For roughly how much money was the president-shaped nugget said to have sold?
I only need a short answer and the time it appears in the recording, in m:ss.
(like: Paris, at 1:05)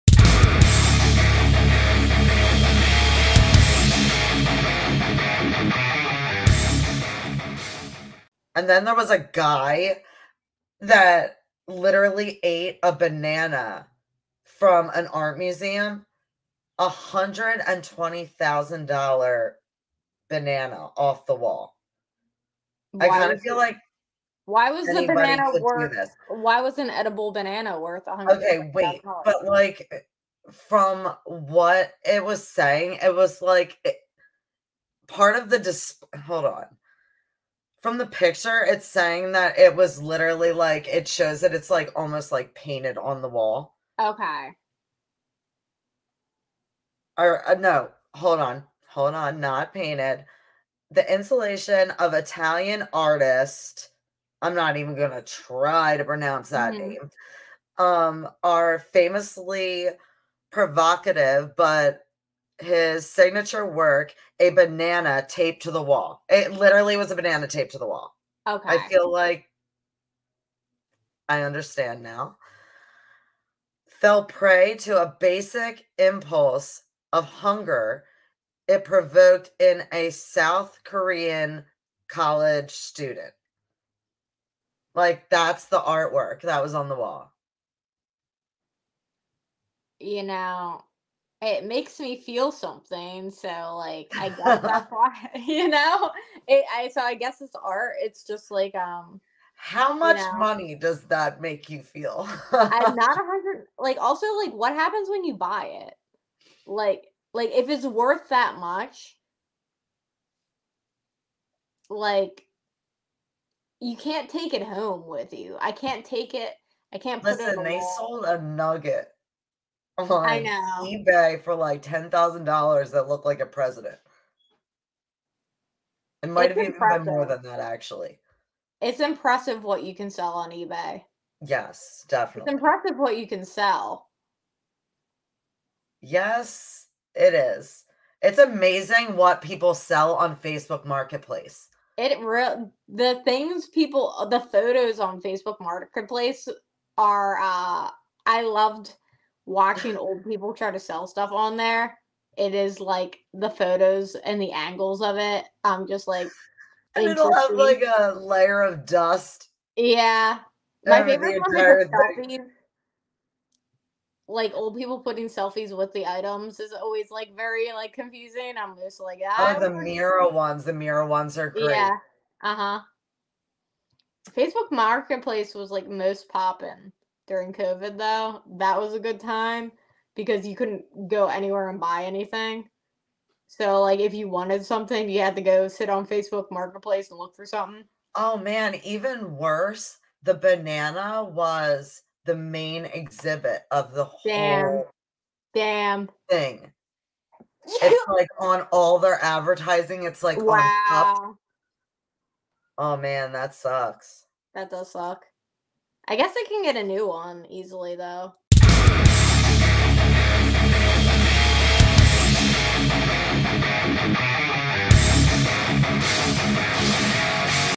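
$10,000, at 2:01.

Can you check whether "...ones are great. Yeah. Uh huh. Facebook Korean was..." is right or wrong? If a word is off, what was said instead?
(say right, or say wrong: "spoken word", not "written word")
wrong: "Marketplace", not "Korean".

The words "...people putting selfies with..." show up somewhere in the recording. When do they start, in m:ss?
2:44.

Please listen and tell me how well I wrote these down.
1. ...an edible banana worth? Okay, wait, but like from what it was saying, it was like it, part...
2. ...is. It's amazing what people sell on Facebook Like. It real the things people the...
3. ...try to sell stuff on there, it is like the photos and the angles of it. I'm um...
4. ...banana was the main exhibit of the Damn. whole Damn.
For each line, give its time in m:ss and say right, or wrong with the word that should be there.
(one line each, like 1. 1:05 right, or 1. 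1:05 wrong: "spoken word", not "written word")
1. 0:26 right
2. 2:17 wrong: "Marketplace", not "Like"
3. 2:30 right
4. 3:10 right.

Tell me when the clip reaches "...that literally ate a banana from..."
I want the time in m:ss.
0:10.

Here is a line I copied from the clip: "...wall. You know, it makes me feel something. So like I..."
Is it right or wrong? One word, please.
right.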